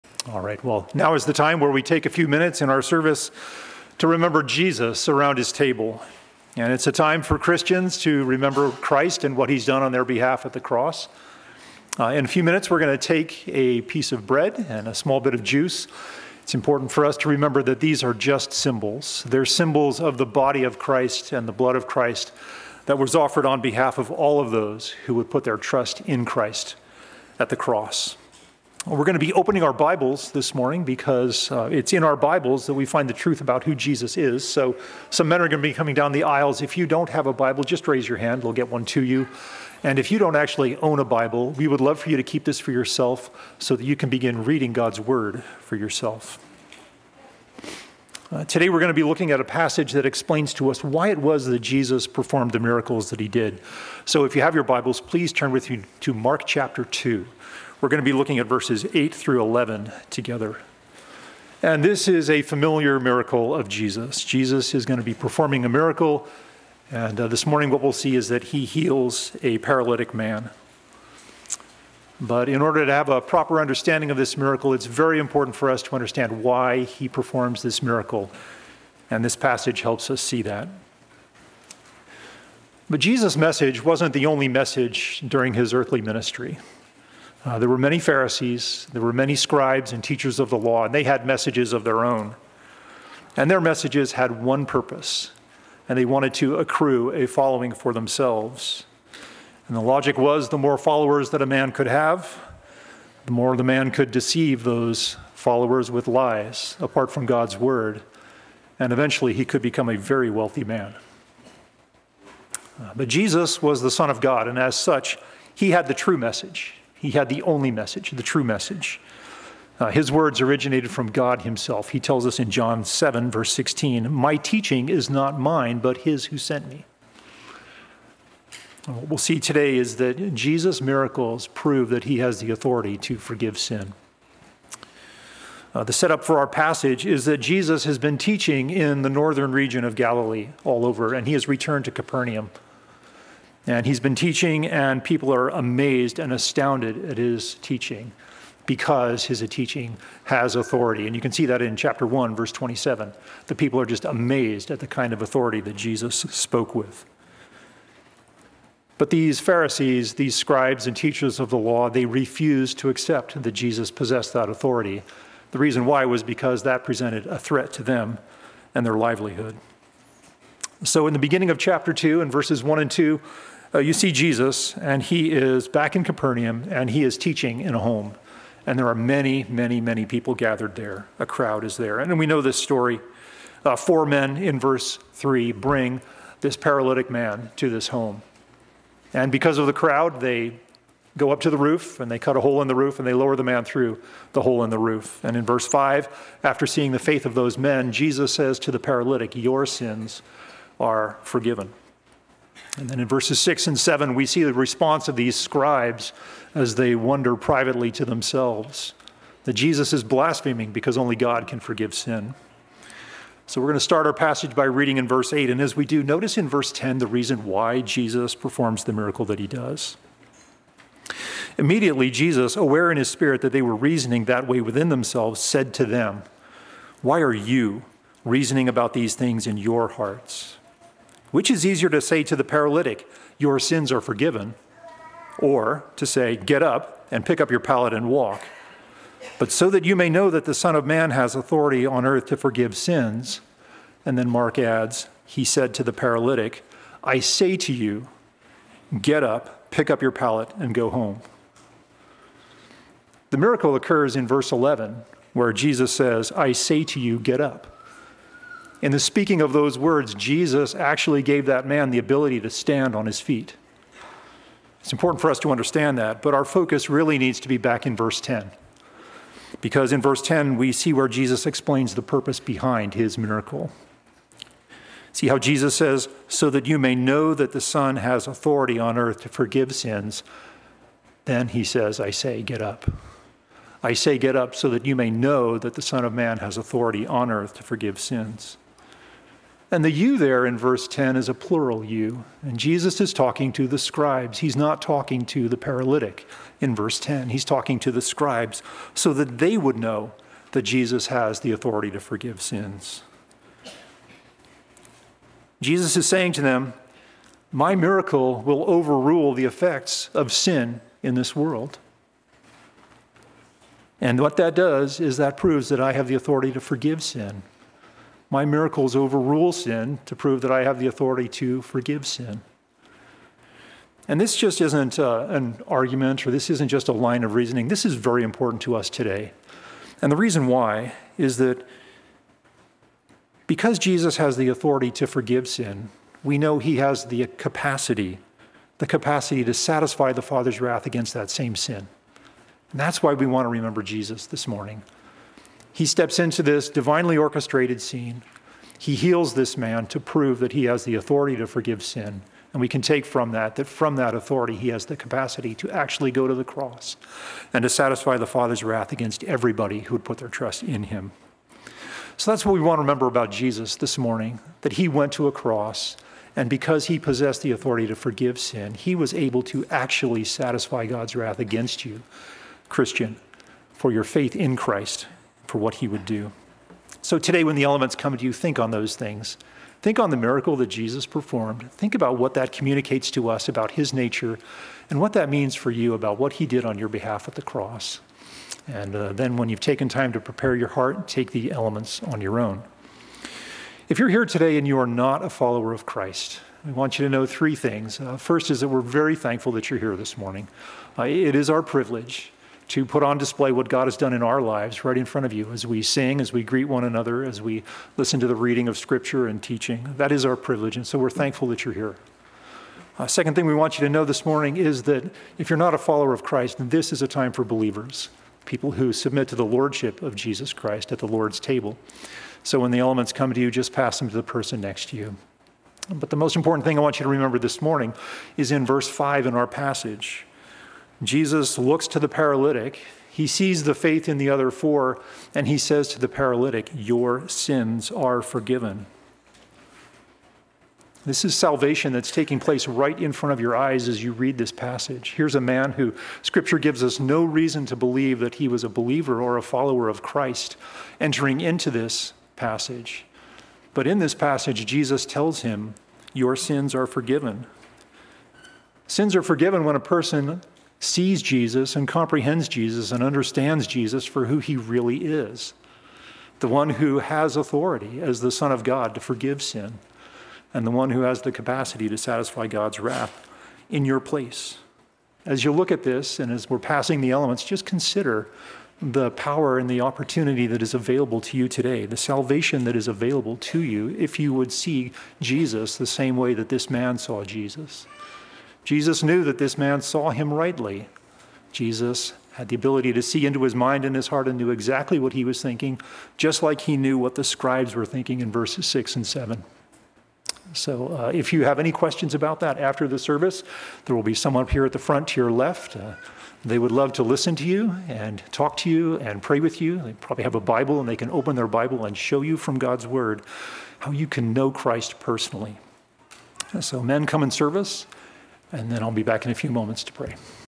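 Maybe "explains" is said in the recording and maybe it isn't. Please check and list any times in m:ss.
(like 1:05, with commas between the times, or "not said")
0:50, 4:31.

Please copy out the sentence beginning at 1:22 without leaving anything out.
But Jesus' message wasn't the only message during his earthly ministry.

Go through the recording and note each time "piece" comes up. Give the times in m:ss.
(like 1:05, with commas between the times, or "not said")
0:13.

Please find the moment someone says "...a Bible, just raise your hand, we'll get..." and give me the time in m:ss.
0:37.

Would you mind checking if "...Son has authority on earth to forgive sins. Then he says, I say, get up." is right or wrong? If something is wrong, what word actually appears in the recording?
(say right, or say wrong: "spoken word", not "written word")
right.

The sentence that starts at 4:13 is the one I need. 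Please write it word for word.
The miracle occurs in verse 11, where Jesus says, I say to you, get up.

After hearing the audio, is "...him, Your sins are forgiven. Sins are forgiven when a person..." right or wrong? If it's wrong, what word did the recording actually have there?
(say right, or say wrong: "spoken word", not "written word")
right.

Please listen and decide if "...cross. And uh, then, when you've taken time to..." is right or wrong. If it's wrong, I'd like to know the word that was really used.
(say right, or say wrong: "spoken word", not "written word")
right.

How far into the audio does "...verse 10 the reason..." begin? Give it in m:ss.
3:36.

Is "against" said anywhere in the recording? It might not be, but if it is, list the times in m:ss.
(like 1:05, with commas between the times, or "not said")
5:40, 5:58, 6:11.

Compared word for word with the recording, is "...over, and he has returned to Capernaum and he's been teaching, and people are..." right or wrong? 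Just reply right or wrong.
right.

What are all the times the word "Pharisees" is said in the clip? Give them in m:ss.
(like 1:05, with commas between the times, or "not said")
1:27, 2:39.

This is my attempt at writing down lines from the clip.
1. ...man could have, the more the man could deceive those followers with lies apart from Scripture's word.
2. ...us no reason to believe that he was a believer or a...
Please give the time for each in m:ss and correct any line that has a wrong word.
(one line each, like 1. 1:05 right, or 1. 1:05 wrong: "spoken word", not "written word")
1. 1:41 wrong: "God", not "Scripture"
2. 7:26 right.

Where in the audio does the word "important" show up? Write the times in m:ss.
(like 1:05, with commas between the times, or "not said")
0:16, 1:15, 4:24, 5:28, 7:06.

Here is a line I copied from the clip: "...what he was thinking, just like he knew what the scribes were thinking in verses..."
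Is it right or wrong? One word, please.
right.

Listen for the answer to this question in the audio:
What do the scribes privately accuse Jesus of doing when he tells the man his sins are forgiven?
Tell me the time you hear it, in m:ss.
3:30.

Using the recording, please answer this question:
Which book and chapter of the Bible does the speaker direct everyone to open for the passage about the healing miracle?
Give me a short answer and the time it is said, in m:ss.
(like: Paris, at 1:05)
Mark 2, at 0:56.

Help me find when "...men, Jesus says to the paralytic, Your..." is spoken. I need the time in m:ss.
3:17.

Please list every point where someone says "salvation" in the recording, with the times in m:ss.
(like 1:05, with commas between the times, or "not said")
7:21, 8:01.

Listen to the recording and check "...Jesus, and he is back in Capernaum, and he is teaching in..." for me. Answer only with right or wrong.
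right.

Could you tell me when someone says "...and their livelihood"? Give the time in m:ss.
2:48.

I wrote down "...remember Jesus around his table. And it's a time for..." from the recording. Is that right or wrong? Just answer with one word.
right.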